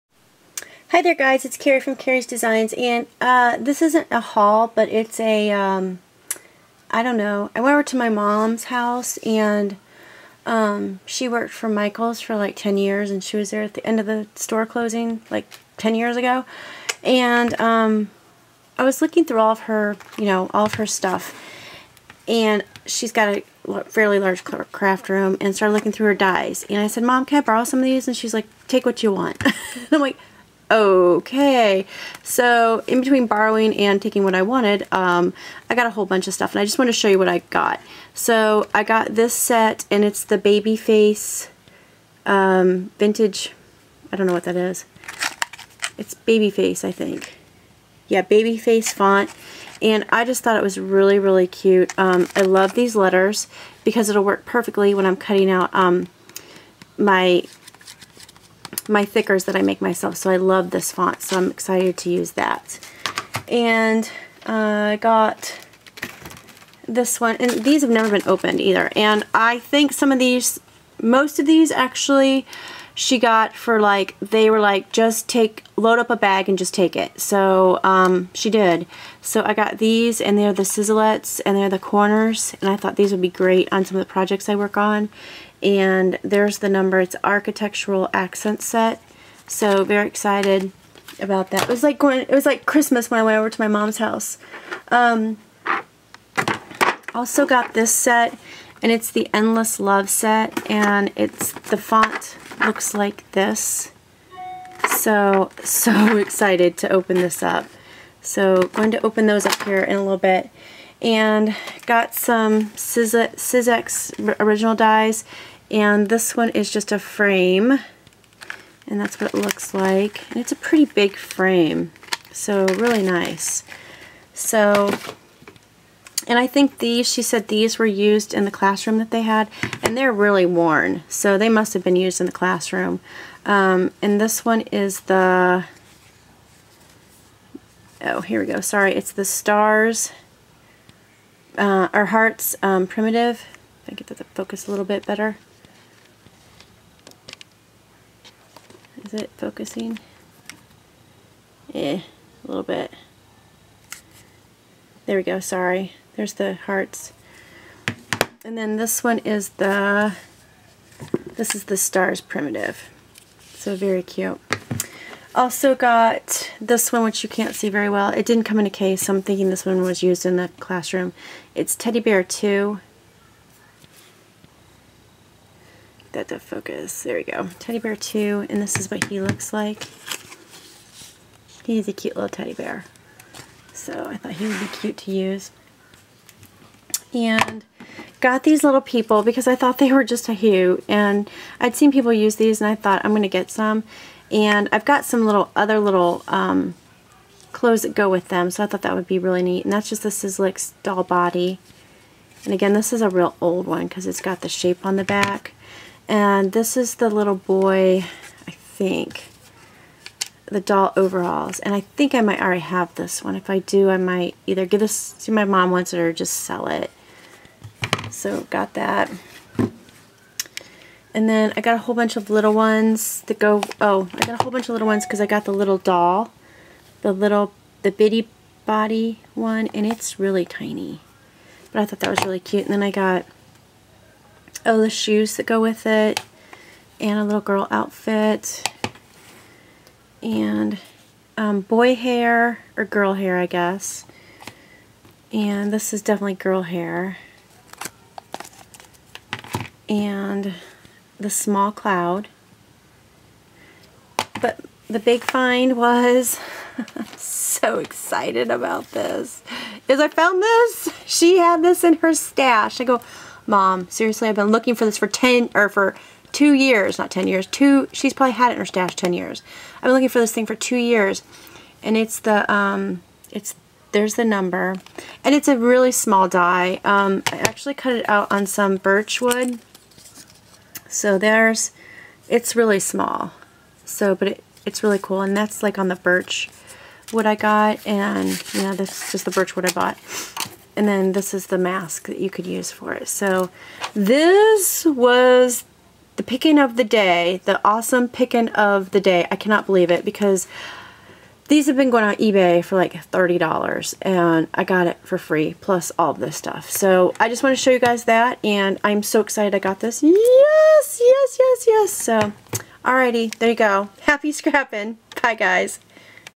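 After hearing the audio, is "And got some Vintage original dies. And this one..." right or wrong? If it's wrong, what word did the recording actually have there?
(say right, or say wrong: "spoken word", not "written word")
wrong: "Siz", not "Vintage".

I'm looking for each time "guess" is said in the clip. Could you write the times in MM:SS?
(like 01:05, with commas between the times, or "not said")
04:03.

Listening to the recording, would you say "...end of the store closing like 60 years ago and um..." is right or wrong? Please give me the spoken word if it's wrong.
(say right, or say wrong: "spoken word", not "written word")
wrong: "10", not "60".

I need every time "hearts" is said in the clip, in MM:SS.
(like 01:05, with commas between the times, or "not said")
02:22, 02:36.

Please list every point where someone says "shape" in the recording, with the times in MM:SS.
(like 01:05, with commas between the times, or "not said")
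03:24.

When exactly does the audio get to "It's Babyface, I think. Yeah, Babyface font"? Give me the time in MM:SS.
00:45.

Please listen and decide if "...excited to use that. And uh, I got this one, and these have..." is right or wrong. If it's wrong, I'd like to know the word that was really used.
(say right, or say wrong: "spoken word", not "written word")
right.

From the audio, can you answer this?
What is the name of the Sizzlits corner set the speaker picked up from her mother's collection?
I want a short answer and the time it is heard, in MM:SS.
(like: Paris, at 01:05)
Architectural Accent Set, at 01:27.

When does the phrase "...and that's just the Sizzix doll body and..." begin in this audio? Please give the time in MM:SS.
03:19.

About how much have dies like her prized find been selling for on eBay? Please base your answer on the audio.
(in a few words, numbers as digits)
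$30.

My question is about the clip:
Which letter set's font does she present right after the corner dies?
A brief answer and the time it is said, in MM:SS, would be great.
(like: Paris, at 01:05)
Endless Love, at 01:39.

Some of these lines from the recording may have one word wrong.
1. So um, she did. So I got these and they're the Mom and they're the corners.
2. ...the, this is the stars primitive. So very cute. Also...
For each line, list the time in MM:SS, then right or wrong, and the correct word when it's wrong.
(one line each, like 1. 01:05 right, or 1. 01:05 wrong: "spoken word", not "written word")
1. 01:17 wrong: "Sizzlits", not "Mom"
2. 02:39 right.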